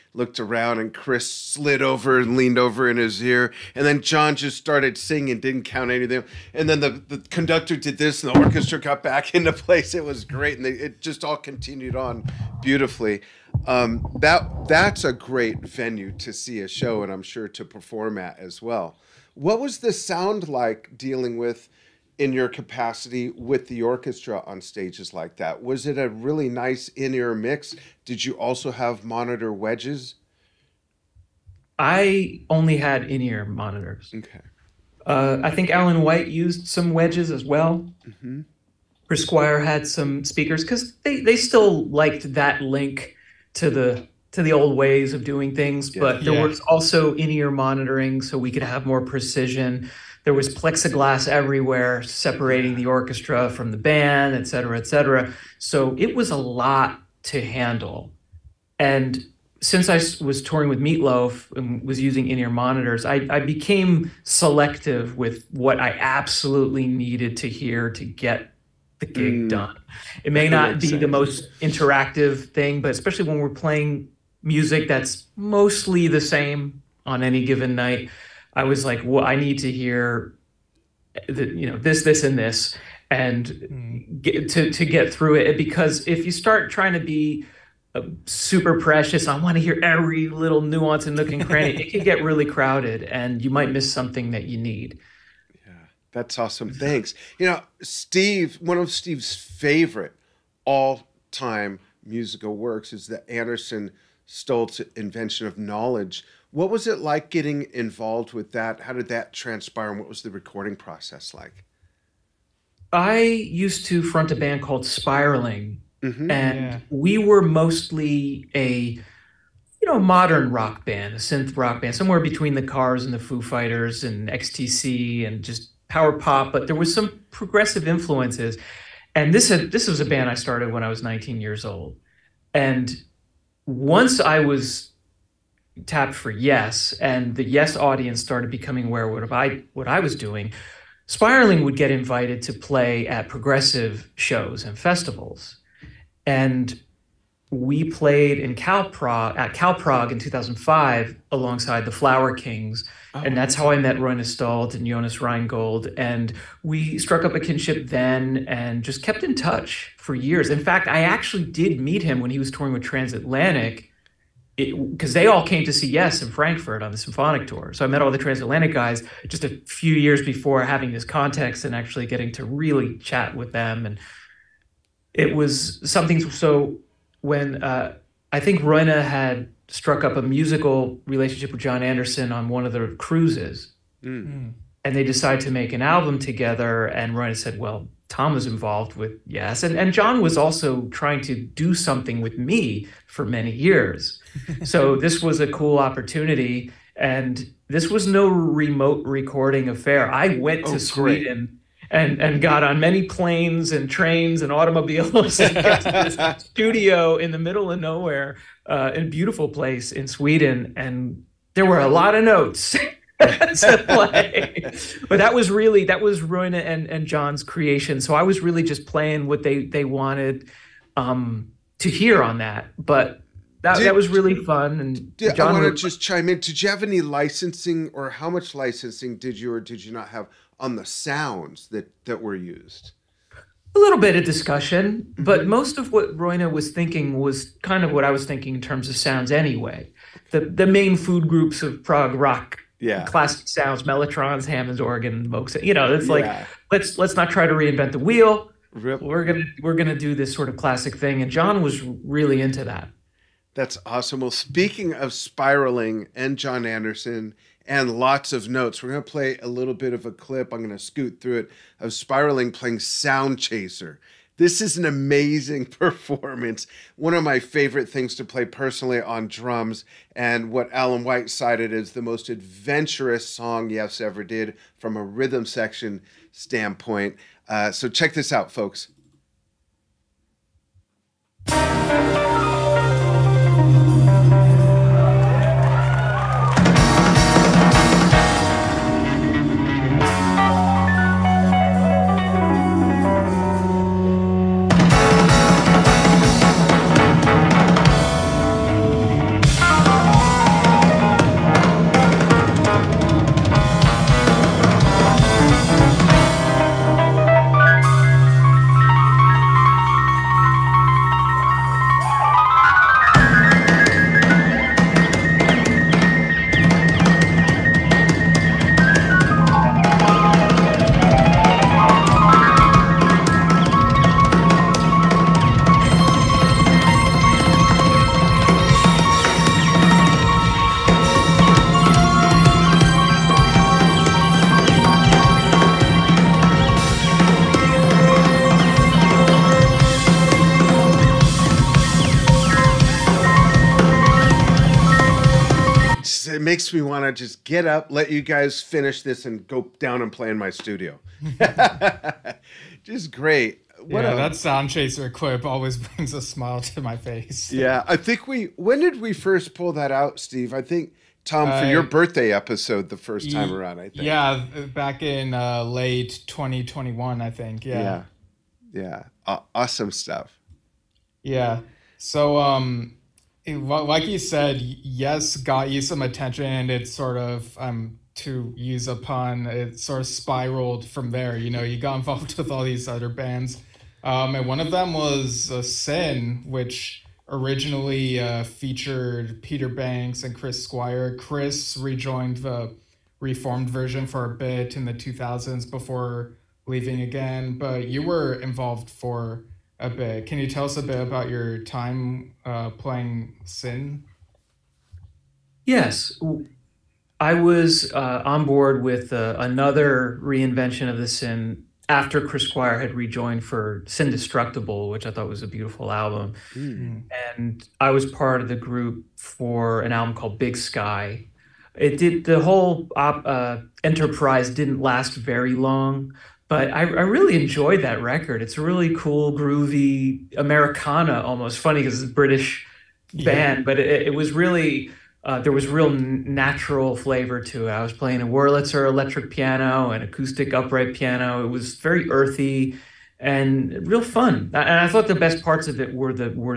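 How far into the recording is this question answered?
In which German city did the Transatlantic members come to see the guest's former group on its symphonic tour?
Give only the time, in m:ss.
2:46.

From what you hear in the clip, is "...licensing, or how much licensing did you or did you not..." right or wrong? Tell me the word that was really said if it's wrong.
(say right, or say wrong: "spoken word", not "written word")
right.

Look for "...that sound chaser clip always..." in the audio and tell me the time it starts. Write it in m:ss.
5:54.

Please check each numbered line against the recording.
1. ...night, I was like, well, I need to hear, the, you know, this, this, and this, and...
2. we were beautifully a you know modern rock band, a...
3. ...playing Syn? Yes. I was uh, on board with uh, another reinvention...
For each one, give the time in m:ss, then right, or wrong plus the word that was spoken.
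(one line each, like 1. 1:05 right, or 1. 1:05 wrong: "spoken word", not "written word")
1. 1:17 right
2. 1:56 wrong: "mostly", not "beautifully"
3. 6:42 right.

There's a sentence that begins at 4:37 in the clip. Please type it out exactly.
Uh, so check this out, folks.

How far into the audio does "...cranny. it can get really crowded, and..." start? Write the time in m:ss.
1:31.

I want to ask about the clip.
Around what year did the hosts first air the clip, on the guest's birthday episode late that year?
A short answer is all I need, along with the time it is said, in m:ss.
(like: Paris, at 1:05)
2021, at 6:06.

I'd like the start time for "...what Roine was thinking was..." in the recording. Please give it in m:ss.
3:55.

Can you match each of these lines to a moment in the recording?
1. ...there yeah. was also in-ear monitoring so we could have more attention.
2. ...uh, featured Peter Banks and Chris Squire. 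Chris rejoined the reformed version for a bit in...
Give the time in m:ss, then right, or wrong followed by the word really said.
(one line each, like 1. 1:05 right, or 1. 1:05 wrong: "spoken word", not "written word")
1. 0:46 wrong: "precision", not "attention"
2. 6:28 right.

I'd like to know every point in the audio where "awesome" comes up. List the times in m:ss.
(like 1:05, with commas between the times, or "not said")
1:36, 4:13, 6:09.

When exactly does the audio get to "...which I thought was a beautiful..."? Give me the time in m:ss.
6:54.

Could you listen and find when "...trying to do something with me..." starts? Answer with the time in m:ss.
3:10.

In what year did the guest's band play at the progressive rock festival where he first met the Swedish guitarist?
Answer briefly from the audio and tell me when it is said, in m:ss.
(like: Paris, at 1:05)
2005, at 2:30.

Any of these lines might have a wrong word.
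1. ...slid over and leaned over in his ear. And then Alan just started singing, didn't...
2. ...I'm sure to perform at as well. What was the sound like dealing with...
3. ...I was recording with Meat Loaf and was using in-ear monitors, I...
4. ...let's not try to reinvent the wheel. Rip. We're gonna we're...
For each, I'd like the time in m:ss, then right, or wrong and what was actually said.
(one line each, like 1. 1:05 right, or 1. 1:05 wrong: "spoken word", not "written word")
1. 0:01 wrong: "Jon", not "Alan"
2. 0:17 right
3. 0:59 wrong: "touring", not "recording"
4. 4:06 right.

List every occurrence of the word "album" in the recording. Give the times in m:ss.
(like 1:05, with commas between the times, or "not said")
3:05, 6:55, 6:59.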